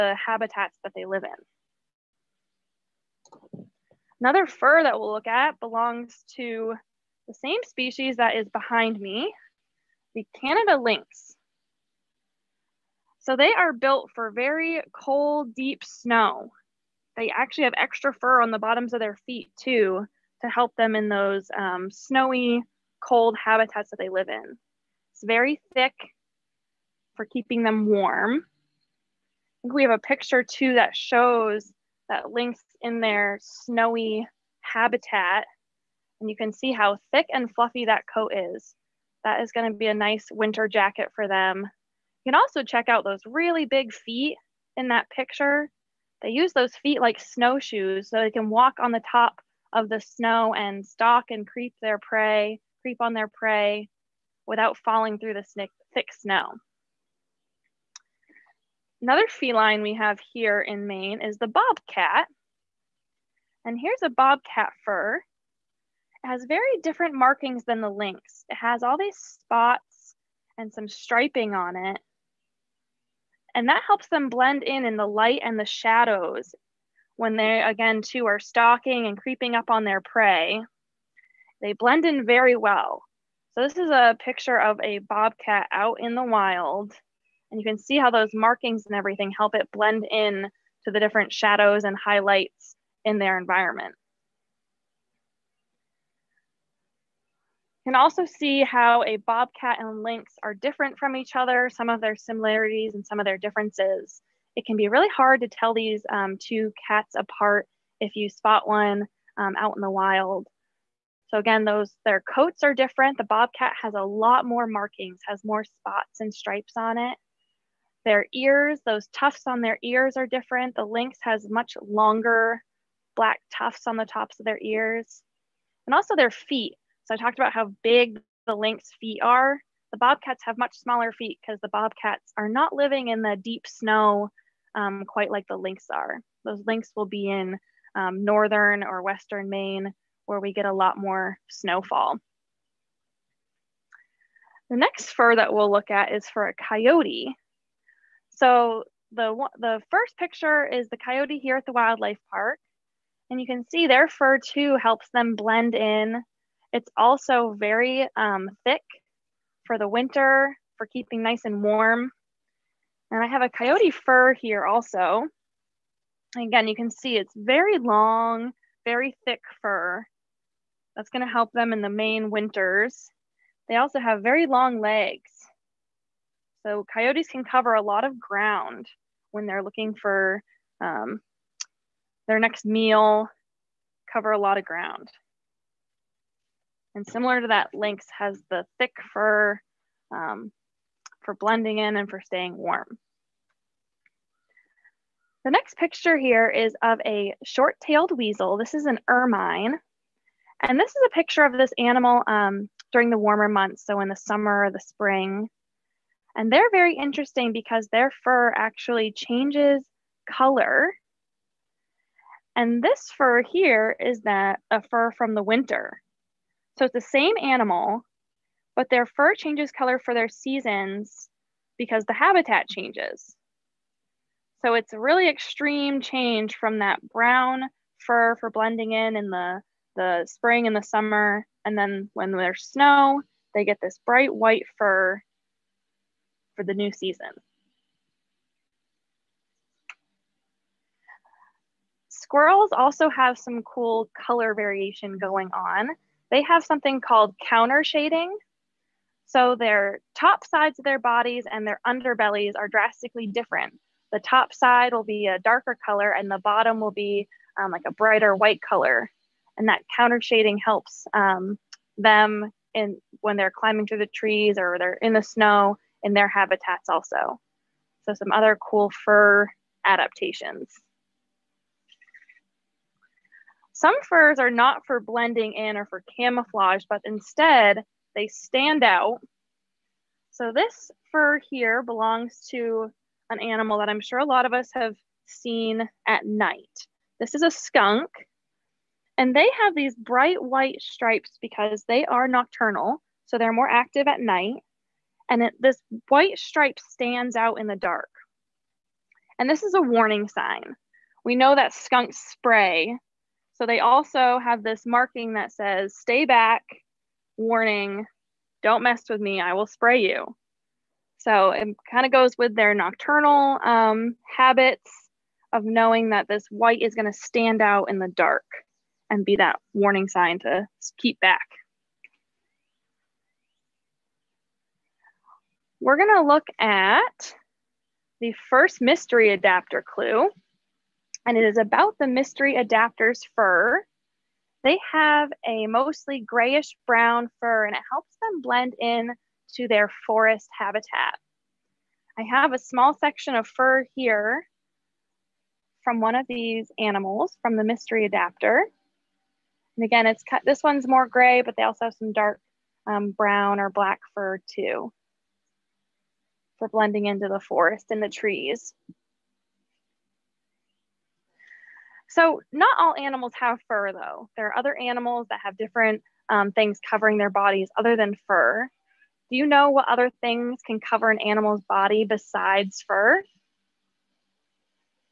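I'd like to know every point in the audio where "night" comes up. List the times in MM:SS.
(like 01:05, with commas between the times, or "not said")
04:46, 04:54.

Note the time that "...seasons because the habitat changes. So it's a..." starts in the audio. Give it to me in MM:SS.
03:40.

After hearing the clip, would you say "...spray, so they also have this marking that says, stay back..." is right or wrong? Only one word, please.
right.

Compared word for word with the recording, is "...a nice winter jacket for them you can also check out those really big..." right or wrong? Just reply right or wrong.
right.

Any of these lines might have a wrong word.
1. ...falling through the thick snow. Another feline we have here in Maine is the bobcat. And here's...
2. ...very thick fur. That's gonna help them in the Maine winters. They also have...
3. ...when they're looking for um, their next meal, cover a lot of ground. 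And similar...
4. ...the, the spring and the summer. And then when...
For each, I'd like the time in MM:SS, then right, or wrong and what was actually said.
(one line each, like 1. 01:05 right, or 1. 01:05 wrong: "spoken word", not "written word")
1. 00:54 right
2. 02:48 right
3. 02:59 right
4. 03:49 right.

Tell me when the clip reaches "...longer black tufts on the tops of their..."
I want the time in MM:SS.
02:01.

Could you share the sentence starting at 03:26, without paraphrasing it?
And they're very interesting because their fur actually changes color.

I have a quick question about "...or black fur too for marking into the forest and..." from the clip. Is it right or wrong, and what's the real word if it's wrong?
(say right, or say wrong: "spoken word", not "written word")
wrong: "blending", not "marking".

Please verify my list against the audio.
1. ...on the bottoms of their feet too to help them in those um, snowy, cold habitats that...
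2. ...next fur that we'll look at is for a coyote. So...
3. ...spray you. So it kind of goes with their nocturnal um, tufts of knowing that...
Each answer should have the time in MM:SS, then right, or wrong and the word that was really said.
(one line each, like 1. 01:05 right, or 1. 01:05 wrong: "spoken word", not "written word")
1. 00:18 right
2. 02:24 right
3. 05:09 wrong: "habits", not "tufts".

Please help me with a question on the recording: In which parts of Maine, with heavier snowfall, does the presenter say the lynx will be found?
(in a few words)
Northern or western Maine.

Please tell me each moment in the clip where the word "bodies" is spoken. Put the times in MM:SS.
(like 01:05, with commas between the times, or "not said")
04:10, 06:07.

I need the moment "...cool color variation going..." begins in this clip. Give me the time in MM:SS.
04:03.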